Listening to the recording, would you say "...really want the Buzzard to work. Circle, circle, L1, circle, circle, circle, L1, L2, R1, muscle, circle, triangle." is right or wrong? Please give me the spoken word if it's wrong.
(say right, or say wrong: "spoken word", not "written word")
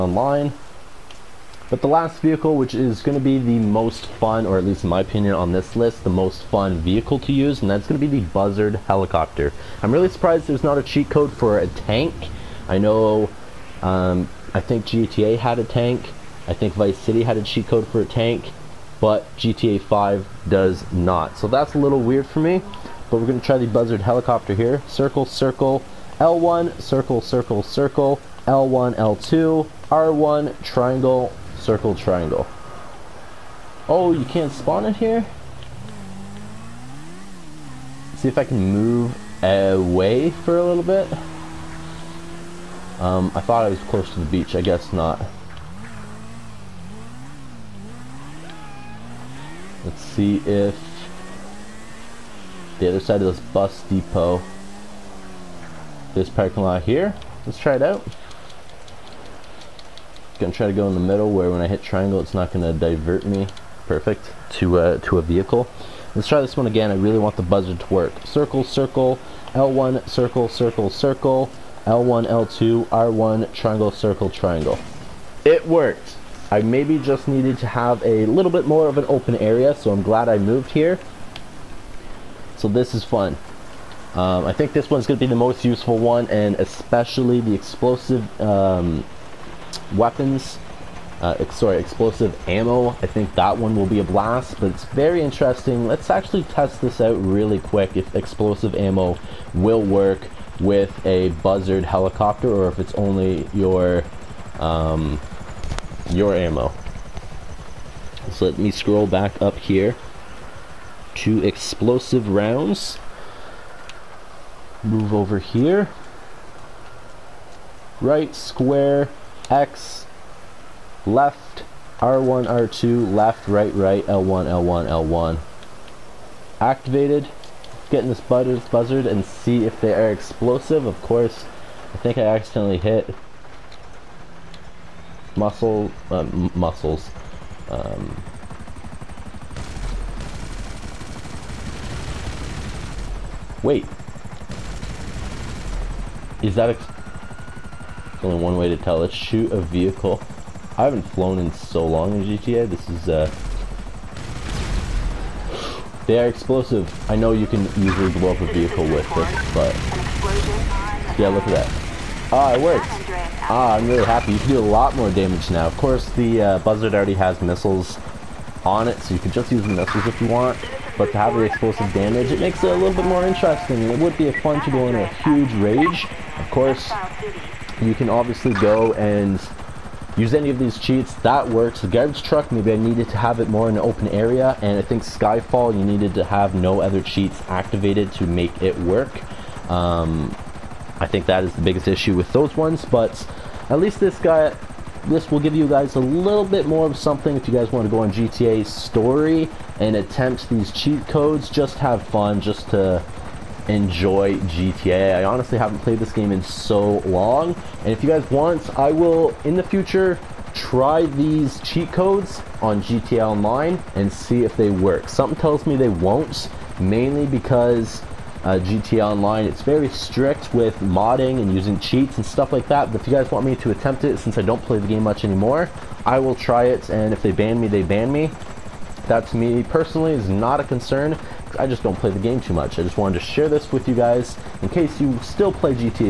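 wrong: "triangle", not "muscle".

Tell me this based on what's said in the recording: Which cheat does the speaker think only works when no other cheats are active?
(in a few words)
Skyfall.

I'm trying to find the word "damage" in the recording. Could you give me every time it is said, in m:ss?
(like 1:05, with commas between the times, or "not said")
2:45, 2:51.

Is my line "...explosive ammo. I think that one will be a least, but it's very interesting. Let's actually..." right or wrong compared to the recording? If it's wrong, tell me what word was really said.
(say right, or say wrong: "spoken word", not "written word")
wrong: "blast", not "least".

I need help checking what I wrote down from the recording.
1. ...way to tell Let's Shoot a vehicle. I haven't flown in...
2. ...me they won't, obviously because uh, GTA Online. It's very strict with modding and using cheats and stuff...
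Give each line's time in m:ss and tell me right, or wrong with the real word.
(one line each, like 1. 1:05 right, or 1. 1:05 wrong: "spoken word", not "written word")
1. 2:28 right
2. 3:35 wrong: "mainly", not "obviously".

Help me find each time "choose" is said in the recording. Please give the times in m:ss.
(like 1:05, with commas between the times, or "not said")
not said.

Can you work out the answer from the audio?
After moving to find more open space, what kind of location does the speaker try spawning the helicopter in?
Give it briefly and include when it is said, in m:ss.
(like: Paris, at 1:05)
bus depot, at 0:53.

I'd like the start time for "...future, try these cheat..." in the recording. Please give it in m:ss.
3:29.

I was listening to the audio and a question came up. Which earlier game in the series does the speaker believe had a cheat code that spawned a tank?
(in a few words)
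Vice City.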